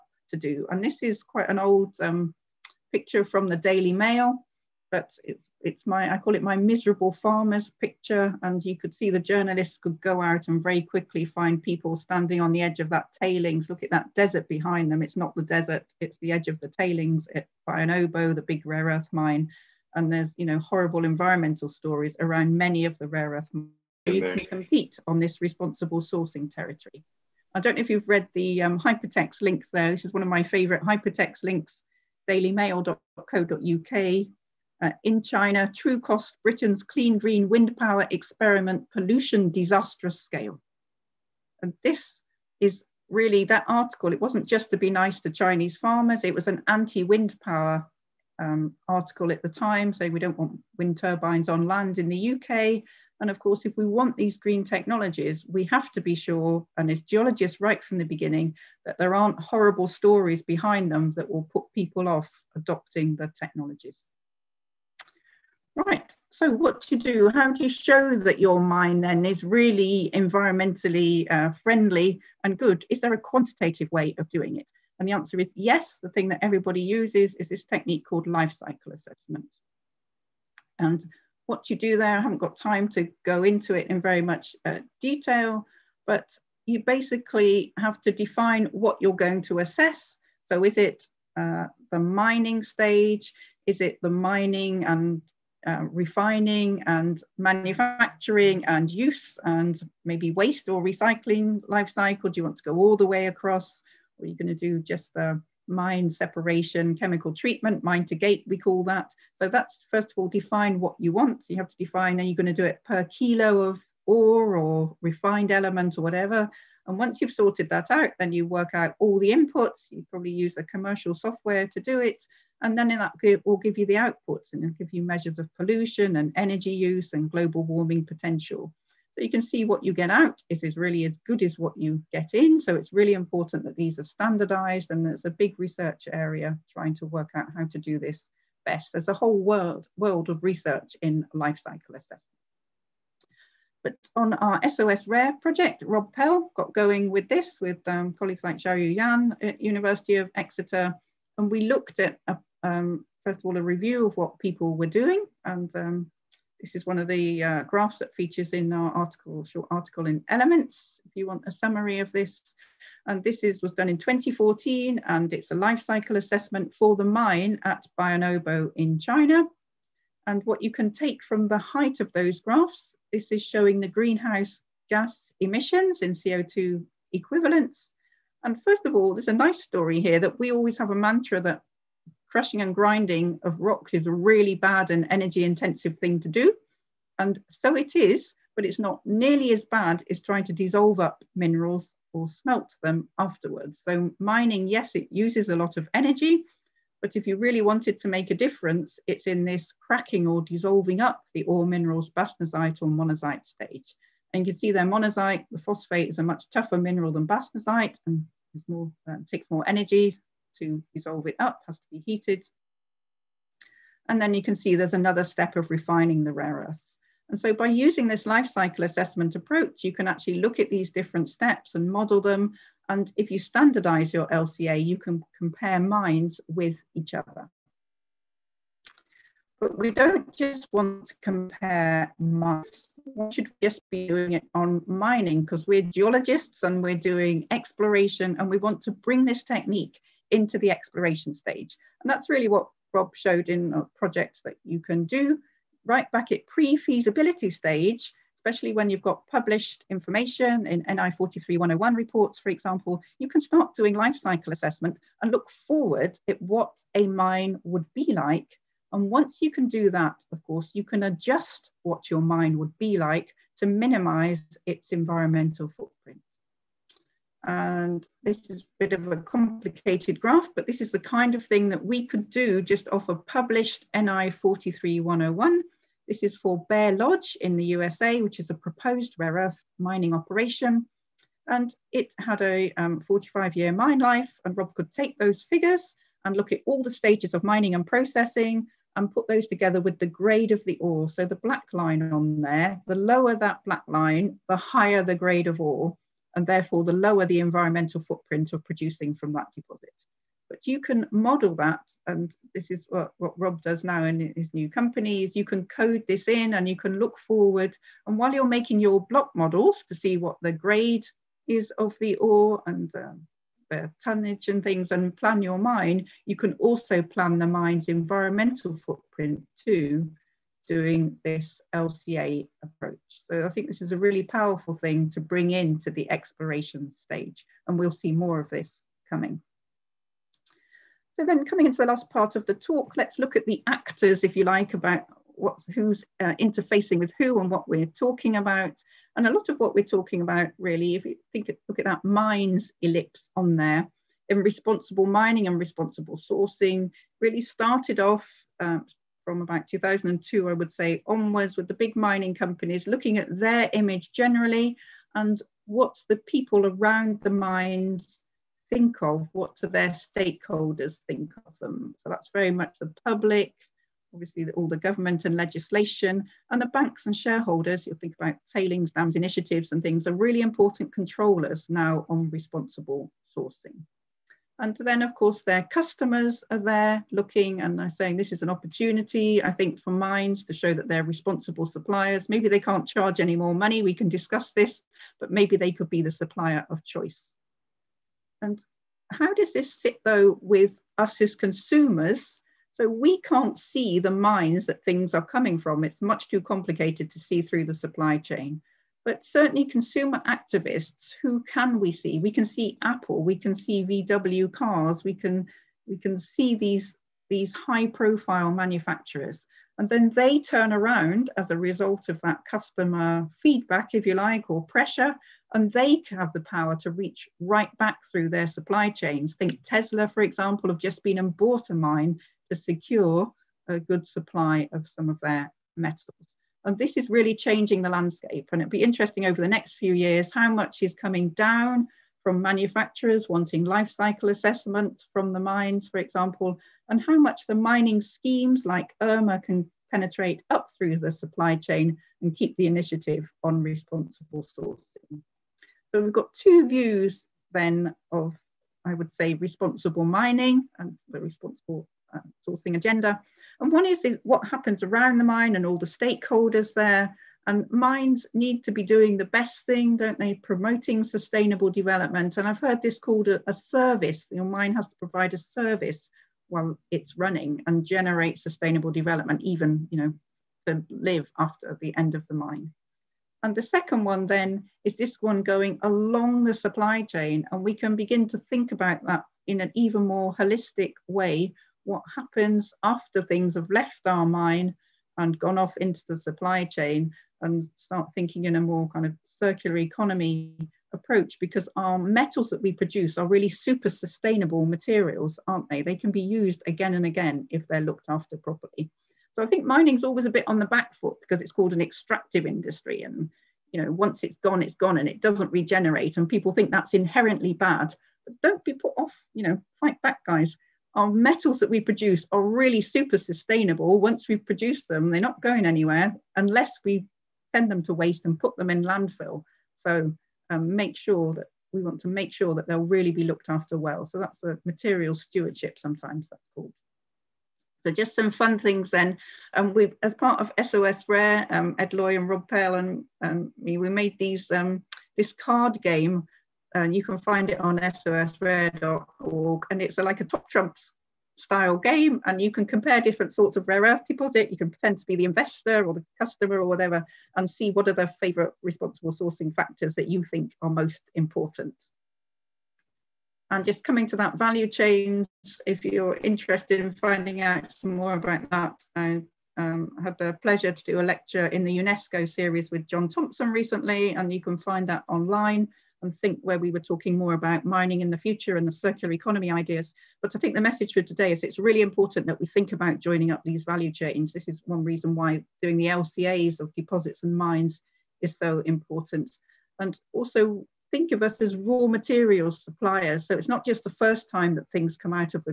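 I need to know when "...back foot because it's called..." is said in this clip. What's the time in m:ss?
8:20.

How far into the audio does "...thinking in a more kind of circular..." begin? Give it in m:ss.
8:08.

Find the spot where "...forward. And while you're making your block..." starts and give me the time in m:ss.
5:07.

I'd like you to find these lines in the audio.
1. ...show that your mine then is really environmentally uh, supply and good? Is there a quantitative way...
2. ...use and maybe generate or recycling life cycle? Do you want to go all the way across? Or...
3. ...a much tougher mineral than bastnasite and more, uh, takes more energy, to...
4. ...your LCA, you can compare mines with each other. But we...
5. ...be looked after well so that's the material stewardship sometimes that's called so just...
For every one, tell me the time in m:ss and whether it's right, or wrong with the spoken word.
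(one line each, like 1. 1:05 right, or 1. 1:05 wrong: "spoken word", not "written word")
1. 1:07 wrong: "friendly", not "supply"
2. 1:38 wrong: "waste", not "generate"
3. 3:26 right
4. 3:44 right
5. 8:43 right.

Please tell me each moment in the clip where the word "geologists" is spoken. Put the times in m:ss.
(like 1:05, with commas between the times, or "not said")
0:57, 3:55.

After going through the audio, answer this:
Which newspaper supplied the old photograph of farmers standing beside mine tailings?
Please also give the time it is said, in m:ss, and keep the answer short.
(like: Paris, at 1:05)
Daily Mail, at 0:03.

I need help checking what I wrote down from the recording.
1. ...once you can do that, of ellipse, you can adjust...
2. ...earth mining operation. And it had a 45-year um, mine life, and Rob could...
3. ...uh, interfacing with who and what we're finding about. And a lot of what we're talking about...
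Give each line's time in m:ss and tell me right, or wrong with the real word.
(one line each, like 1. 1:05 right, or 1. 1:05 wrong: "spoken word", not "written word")
1. 4:19 wrong: "course", not "ellipse"
2. 4:39 right
3. 5:36 wrong: "talking", not "finding".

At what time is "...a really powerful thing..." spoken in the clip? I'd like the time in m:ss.
5:23.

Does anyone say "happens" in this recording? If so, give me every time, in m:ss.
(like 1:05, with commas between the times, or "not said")
7:34, 8:02.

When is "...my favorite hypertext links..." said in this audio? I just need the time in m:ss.
0:30.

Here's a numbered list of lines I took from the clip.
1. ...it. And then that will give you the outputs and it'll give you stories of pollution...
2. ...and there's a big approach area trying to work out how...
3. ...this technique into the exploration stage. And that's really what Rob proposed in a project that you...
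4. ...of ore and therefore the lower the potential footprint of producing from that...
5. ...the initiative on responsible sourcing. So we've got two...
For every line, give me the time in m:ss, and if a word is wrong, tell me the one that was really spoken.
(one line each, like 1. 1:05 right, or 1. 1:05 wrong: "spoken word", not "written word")
1. 2:01 wrong: "measures", not "stories"
2. 2:14 wrong: "research", not "approach"
3. 3:59 wrong: "showed", not "proposed"
4. 4:55 wrong: "environmental", not "potential"
5. 7:22 right.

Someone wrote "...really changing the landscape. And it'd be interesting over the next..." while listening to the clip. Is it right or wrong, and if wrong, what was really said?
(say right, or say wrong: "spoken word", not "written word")
right.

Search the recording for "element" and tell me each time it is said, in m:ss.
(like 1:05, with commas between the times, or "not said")
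1:55, 2:40.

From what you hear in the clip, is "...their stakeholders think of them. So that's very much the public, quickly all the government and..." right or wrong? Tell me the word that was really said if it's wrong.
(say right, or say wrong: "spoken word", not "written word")
wrong: "obviously", not "quickly".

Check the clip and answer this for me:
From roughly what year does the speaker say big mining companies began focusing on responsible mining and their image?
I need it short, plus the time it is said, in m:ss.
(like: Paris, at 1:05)
2002, at 5:49.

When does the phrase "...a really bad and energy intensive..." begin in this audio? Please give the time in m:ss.
3:04.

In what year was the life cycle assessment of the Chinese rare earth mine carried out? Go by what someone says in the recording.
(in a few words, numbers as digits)
2014.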